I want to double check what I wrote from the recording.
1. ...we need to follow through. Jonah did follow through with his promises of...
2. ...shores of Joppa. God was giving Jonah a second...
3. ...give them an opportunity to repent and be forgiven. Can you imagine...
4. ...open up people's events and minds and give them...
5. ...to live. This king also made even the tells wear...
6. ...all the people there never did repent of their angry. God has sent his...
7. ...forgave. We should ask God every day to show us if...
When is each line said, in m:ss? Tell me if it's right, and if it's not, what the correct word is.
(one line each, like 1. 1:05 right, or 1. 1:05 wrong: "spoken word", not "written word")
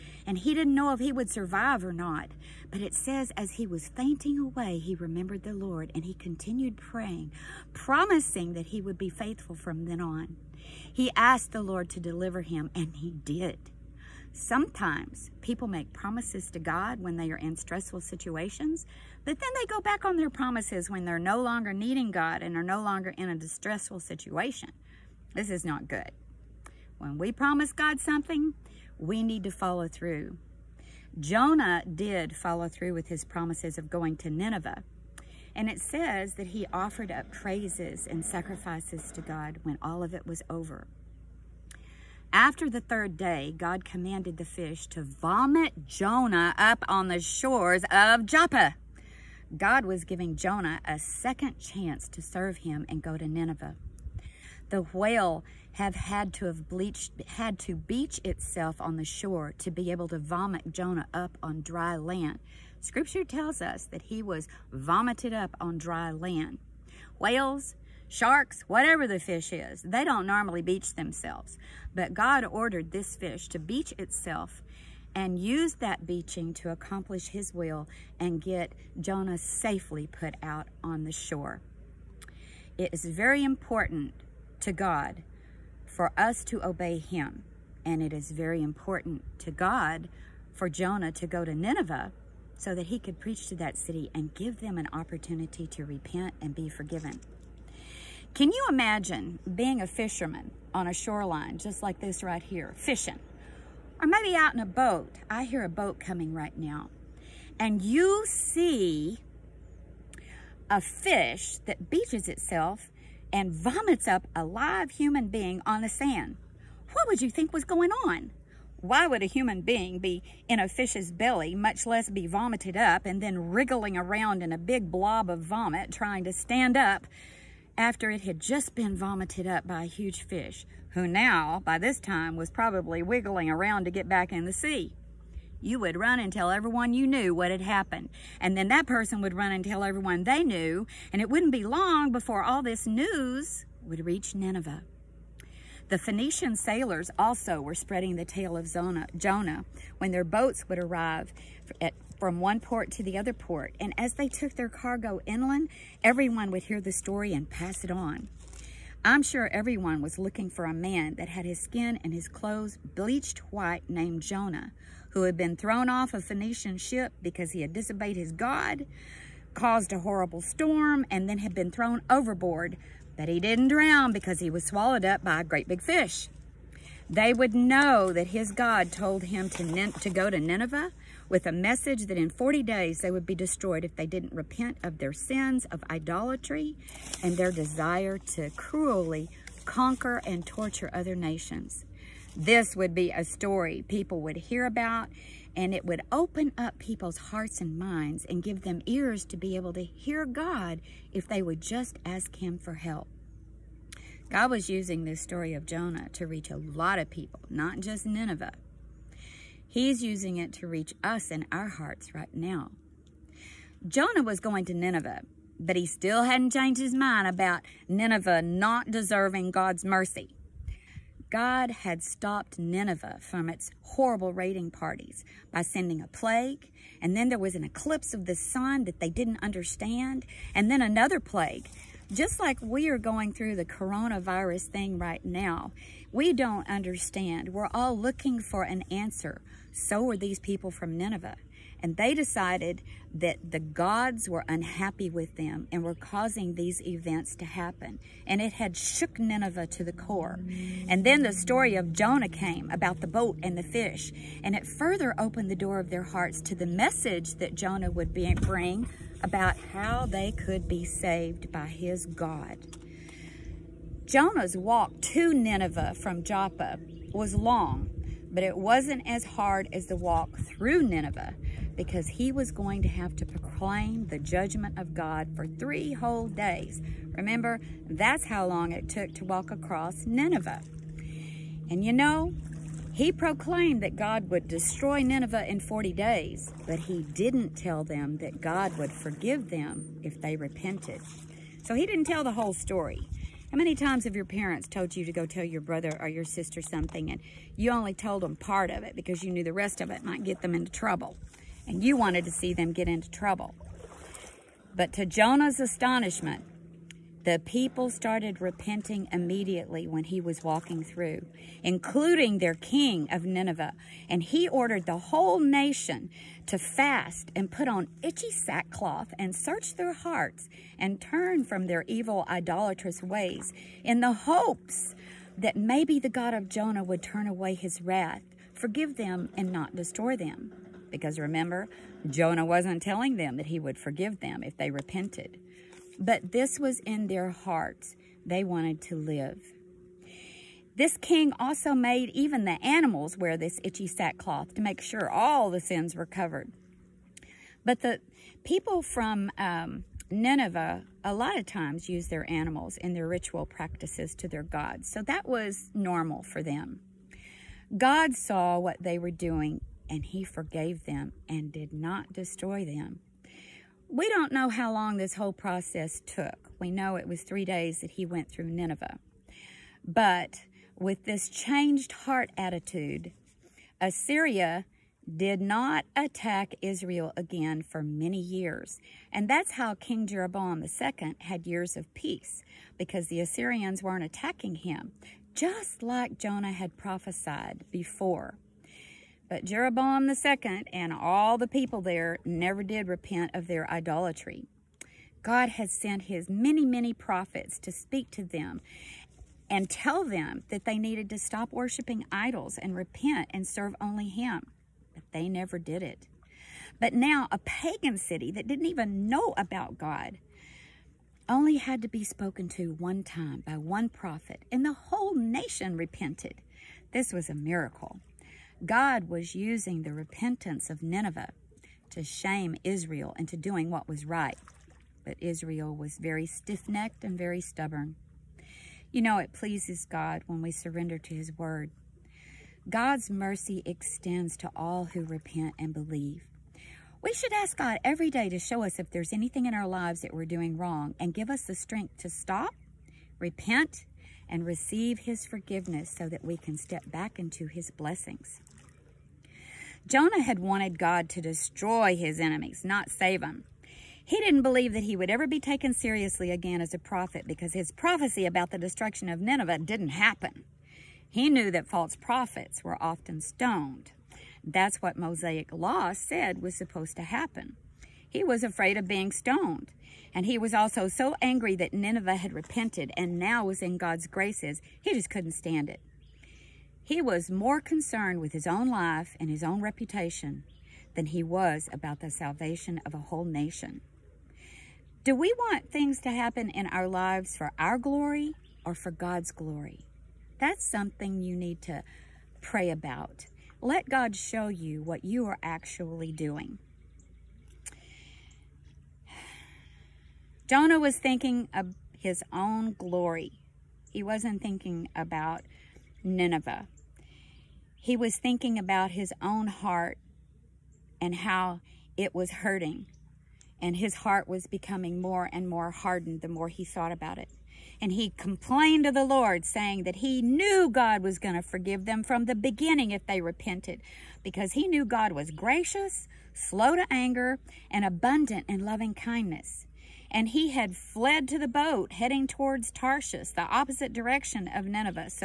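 1. 0:28 right
2. 0:47 right
3. 1:34 right
4. 3:16 wrong: "hearts", not "events"
5. 5:38 wrong: "animals", not "tells"
6. 6:30 wrong: "idolatry", not "angry"
7. 7:15 wrong: "believe", not "forgave".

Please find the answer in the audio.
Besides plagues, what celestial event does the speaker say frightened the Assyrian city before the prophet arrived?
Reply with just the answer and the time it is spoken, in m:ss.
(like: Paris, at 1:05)
eclipse of the sun, at 3:47.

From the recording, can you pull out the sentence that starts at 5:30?
Because remember, Jonah wasn't telling them that he would forgive them if they repented.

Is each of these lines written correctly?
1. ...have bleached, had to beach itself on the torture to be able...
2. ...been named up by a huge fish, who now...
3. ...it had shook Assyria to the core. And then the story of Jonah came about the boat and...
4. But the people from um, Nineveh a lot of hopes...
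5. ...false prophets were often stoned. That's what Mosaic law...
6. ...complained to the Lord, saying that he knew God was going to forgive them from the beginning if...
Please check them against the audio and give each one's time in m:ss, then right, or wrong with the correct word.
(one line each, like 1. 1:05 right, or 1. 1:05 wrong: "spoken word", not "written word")
1. 0:56 wrong: "shore", not "torture"
2. 2:08 wrong: "vomited", not "named"
3. 4:08 wrong: "Nineveh", not "Assyria"
4. 5:47 wrong: "times", not "hopes"
5. 7:41 right
6. 8:38 right.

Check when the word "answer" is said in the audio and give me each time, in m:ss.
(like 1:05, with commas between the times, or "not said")
3:58.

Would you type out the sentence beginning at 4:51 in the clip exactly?
So he didn't tell the whole story.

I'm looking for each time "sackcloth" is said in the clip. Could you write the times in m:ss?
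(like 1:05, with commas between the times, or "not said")
5:18, 5:43.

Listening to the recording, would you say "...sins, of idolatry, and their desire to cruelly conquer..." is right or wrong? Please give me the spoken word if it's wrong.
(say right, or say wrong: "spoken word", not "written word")
right.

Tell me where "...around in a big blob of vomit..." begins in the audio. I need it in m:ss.
2:03.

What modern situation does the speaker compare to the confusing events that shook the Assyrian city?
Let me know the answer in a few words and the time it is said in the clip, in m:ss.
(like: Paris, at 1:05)
coronavirus, at 3:53.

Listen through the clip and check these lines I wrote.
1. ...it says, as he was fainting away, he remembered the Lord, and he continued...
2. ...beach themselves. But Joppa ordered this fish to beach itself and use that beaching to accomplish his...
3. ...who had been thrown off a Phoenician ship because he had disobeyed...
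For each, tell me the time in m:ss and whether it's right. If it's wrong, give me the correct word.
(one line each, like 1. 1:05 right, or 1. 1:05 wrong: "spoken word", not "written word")
1. 0:02 right
2. 1:10 wrong: "God", not "Joppa"
3. 2:45 right.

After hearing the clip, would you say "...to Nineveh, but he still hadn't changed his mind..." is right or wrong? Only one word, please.
right.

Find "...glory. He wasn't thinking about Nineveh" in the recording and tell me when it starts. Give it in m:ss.
8:22.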